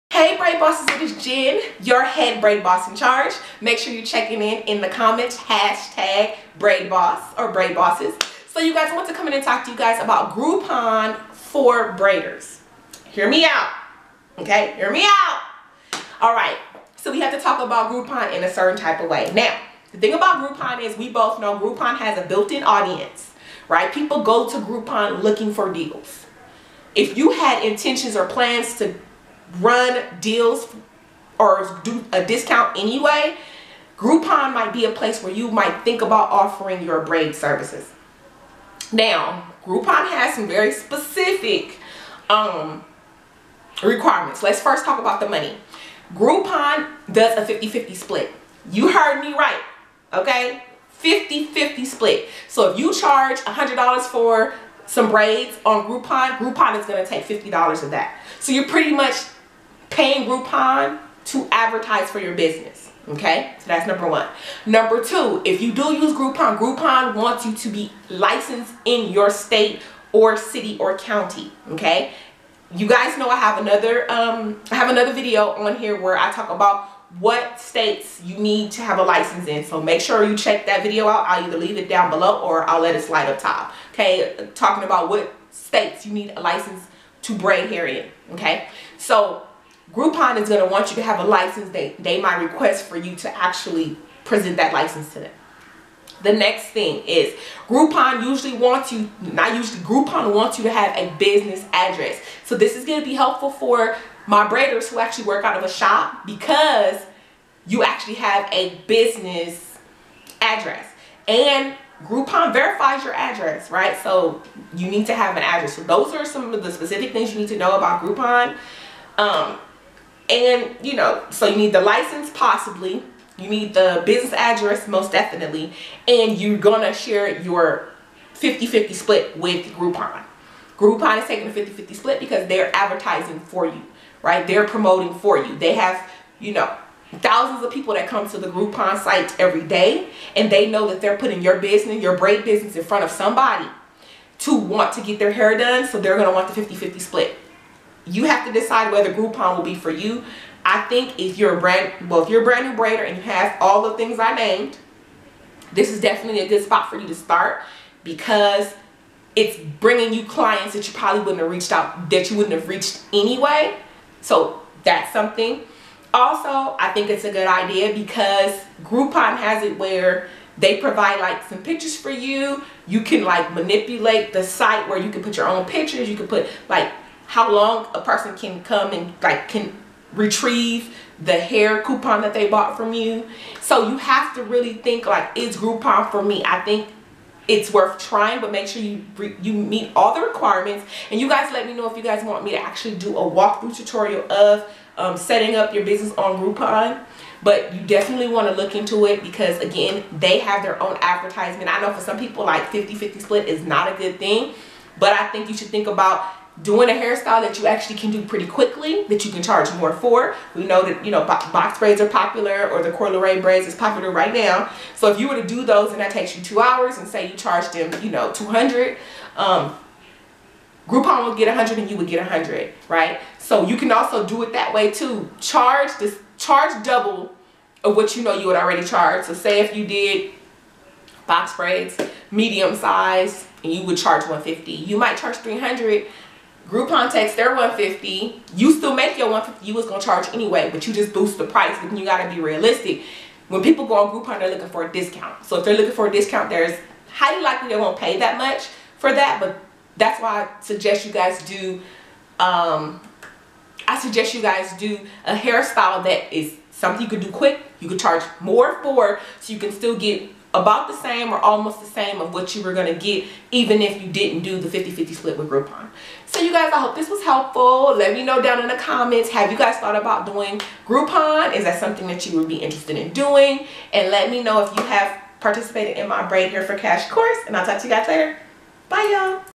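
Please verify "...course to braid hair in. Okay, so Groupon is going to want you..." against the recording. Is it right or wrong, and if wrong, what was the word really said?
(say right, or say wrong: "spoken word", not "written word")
wrong: "license", not "course".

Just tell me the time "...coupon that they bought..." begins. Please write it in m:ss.
3:01.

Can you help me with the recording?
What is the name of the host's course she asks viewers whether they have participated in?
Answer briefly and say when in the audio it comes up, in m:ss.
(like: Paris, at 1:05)
Braid Hair for Cash, at 4:36.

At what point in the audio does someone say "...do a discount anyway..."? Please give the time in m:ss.
0:31.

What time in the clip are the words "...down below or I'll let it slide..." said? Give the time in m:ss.
1:21.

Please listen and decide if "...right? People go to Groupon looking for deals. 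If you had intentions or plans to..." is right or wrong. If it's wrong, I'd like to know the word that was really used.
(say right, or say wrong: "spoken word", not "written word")
right.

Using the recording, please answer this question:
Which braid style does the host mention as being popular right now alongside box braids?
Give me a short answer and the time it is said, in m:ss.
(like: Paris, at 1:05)
Corduroy braids, at 3:32.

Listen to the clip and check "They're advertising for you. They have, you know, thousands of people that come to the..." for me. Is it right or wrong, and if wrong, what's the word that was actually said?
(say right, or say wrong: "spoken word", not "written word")
wrong: "promoting", not "advertising".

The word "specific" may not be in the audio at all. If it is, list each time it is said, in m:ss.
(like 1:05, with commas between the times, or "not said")
0:40, 1:56.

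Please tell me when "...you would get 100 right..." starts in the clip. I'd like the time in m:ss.
3:41.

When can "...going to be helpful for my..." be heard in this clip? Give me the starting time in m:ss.
1:42.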